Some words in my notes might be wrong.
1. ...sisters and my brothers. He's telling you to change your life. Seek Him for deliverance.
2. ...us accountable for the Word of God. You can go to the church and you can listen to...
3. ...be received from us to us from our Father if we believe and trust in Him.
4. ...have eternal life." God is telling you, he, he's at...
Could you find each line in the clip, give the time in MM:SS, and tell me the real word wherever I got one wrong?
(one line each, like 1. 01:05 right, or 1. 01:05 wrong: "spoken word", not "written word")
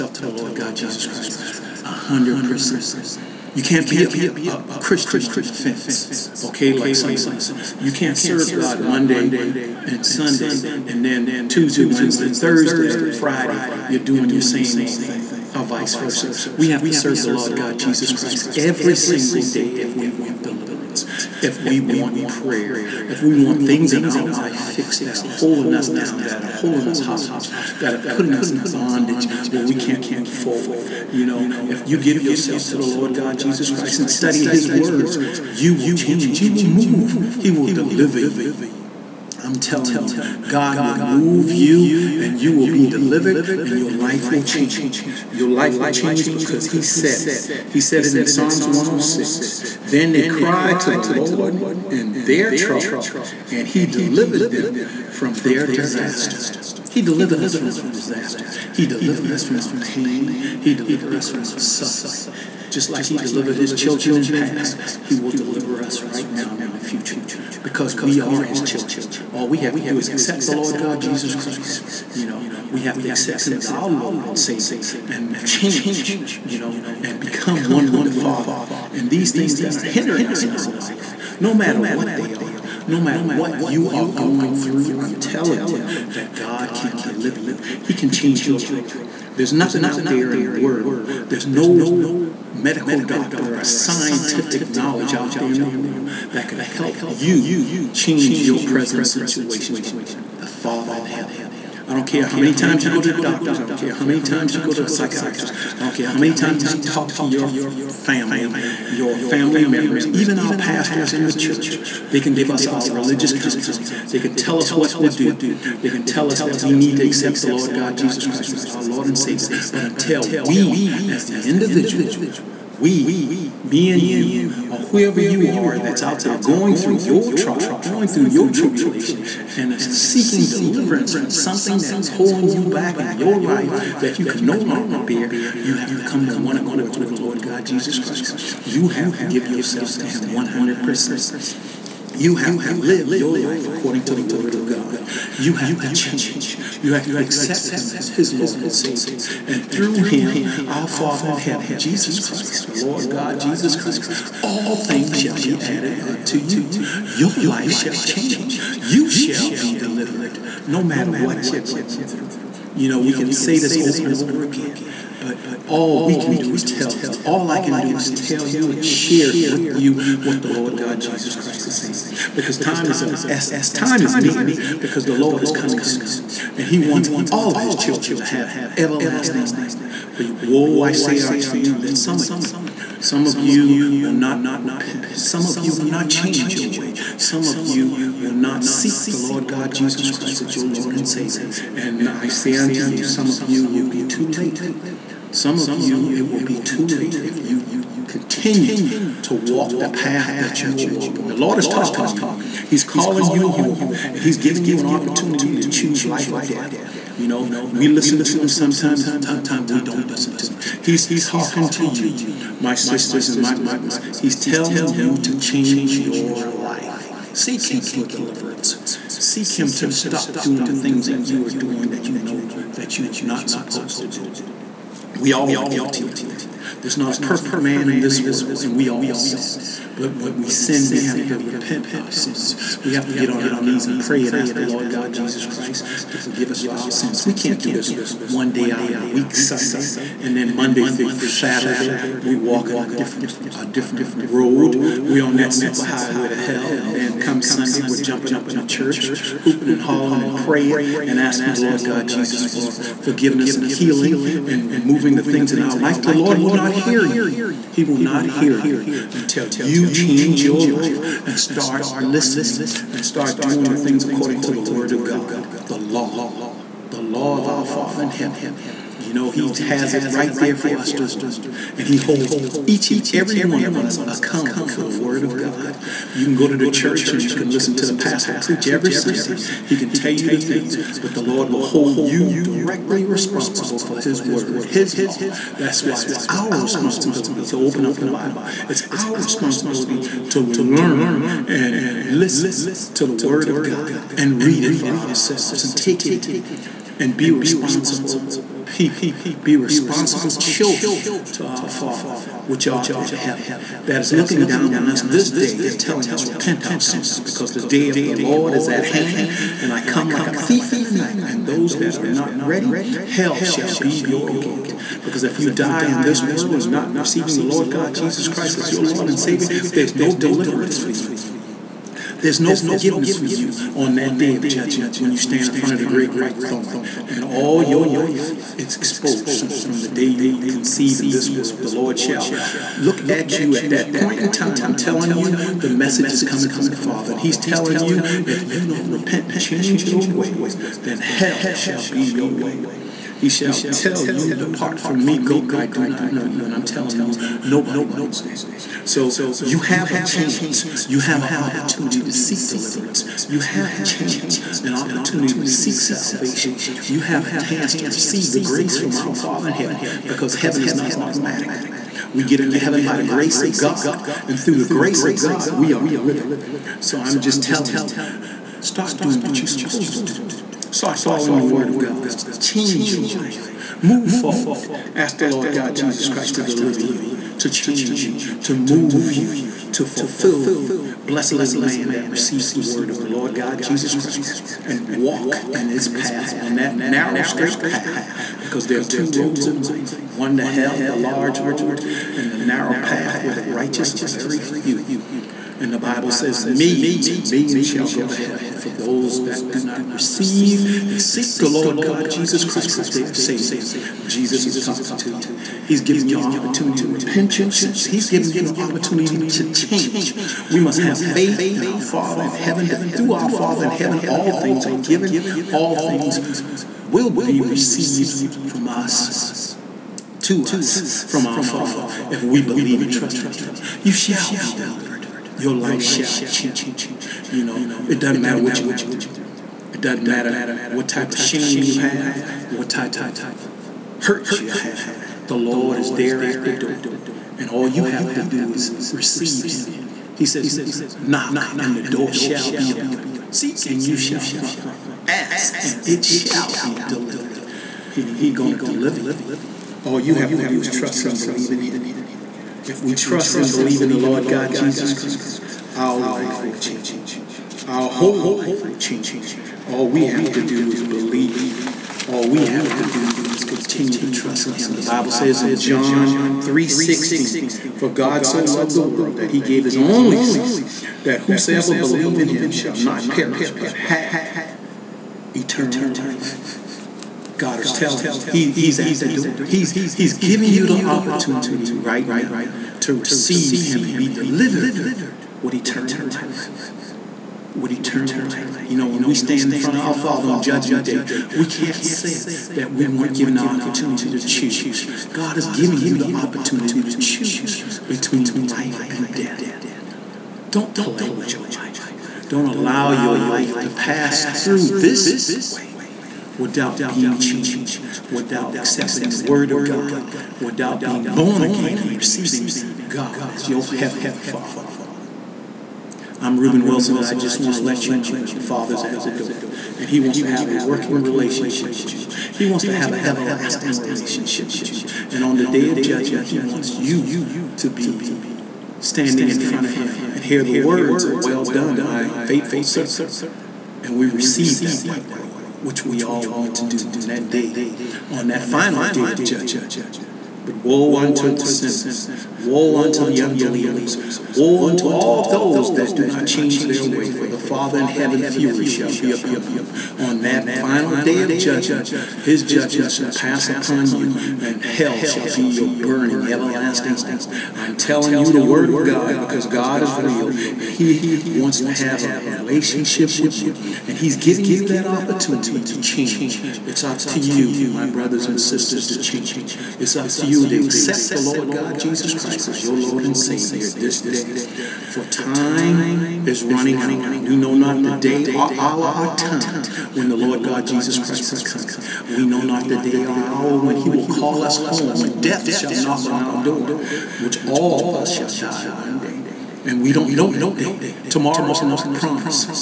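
1. 03:32 right
2. 04:33 right
3. 06:57 right
4. 07:53 right.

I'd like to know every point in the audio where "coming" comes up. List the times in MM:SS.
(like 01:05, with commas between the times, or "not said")
02:55, 05:36, 09:41.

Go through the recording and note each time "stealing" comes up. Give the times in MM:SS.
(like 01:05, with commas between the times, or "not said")
not said.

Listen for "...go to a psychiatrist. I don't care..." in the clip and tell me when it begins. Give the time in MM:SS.
01:44.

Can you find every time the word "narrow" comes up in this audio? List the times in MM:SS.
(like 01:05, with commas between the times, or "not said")
06:26, 06:32.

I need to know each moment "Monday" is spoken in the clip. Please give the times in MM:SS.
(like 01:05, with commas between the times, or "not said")
00:08, 04:00.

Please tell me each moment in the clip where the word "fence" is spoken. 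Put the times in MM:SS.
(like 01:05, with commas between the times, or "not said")
00:05.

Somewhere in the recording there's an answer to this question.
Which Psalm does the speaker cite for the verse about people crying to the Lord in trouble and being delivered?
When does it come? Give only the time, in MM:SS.
00:48.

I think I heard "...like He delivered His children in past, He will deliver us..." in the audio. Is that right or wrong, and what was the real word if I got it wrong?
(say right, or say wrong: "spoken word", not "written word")
right.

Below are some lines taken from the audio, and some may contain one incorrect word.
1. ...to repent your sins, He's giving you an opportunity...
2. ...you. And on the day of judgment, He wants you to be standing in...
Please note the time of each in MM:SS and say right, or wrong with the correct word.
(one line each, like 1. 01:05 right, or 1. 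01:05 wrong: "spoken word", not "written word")
1. 06:46 right
2. 08:44 right.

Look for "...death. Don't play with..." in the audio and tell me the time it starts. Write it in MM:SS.
08:19.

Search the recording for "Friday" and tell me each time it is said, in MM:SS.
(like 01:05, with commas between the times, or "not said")
00:13.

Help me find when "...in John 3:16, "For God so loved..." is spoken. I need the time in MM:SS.
07:45.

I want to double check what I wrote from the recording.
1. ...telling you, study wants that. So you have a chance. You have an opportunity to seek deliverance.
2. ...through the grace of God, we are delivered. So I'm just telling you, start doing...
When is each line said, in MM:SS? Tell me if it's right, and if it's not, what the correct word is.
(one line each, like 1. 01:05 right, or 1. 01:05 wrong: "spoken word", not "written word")
1. 05:46 wrong: "nobody", not "study"
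2. 06:04 right.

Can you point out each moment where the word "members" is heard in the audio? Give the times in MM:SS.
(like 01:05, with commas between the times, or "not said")
01:49.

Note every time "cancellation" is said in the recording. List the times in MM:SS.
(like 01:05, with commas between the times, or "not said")
not said.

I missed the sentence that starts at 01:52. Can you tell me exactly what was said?
They can give us our religious counseling.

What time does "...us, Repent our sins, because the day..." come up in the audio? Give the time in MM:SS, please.
05:06.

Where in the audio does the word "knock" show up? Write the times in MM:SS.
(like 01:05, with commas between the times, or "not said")
07:21, 09:45.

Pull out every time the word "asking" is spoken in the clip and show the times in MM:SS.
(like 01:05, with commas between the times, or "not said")
04:11.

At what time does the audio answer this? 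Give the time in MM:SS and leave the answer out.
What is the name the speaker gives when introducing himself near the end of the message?
08:36.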